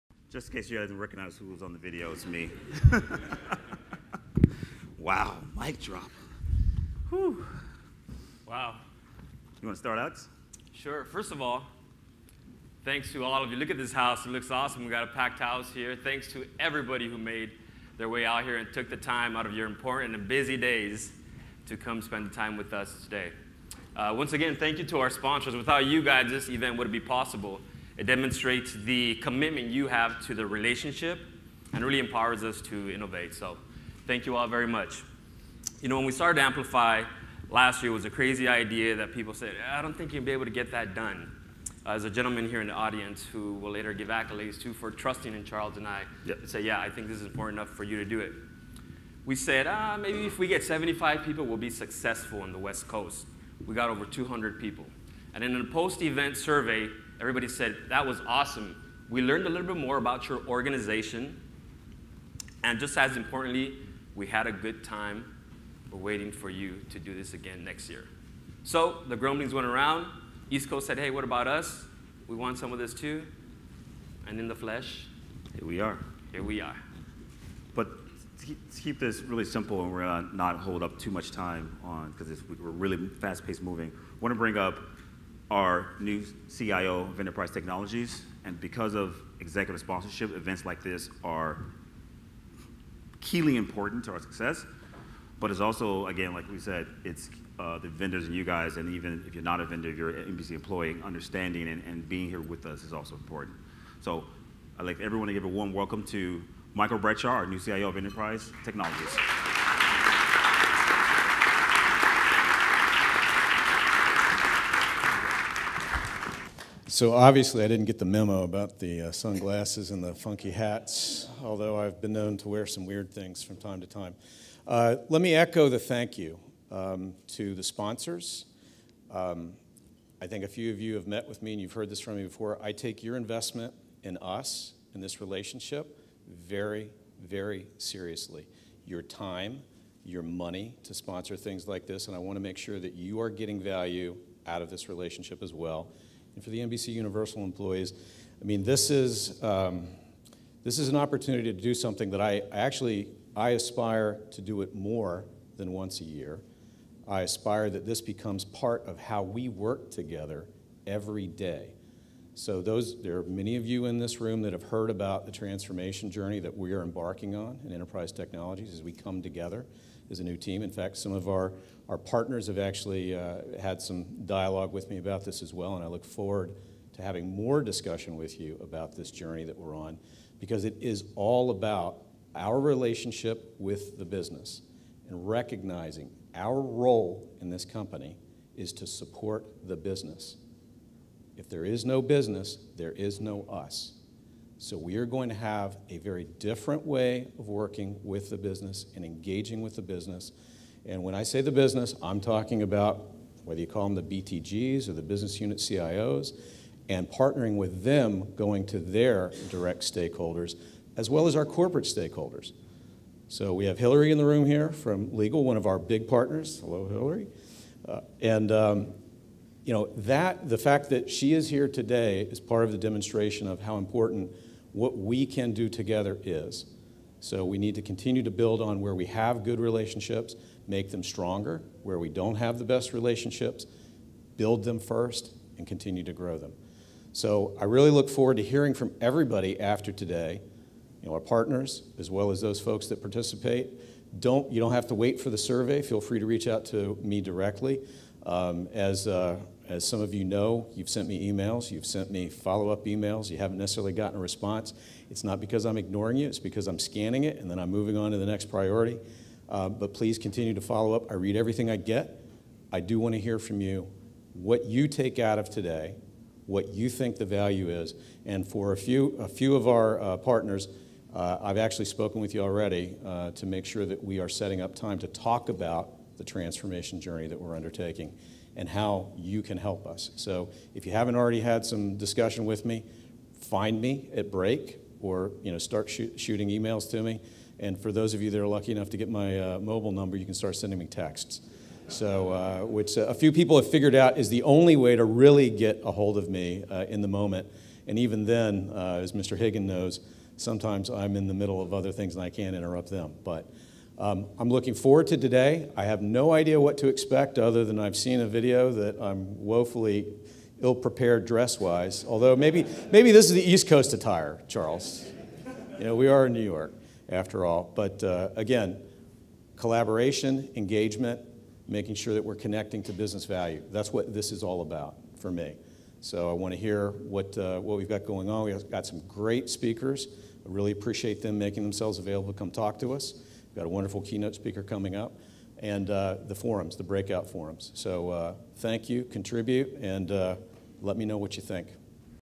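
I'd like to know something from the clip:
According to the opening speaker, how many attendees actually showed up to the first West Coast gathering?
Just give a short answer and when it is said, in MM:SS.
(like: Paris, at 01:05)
Over 200, at 00:53.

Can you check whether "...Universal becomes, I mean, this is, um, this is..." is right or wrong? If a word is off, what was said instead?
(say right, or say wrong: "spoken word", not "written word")
wrong: "employees", not "becomes".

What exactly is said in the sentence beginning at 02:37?
I aspire that this becomes part of how we work together every day.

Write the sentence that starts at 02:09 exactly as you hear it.
Um, I think a few of you have met with me and you've heard this from me before.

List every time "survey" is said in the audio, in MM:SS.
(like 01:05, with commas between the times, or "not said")
00:56, 04:05.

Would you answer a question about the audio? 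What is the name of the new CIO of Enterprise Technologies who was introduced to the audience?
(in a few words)
Michael Bradshaw.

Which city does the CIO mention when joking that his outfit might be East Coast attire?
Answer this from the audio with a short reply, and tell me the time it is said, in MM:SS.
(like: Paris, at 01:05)
New York, at 05:16.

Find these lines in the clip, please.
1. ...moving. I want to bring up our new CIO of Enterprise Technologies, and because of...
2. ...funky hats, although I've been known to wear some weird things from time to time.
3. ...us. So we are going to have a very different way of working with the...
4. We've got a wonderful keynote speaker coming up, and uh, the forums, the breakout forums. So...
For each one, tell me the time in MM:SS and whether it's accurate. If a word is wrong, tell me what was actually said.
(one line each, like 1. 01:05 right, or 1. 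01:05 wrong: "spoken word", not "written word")
1. 01:23 right
2. 02:00 right
3. 03:13 right
4. 05:33 right.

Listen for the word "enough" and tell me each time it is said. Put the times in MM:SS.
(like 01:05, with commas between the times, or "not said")
00:47, 04:48.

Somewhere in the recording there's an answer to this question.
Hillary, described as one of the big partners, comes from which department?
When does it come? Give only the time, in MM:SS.
03:35.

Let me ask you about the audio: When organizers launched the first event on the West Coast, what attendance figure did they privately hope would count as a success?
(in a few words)
75.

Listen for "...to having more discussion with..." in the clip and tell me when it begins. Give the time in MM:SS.
02:56.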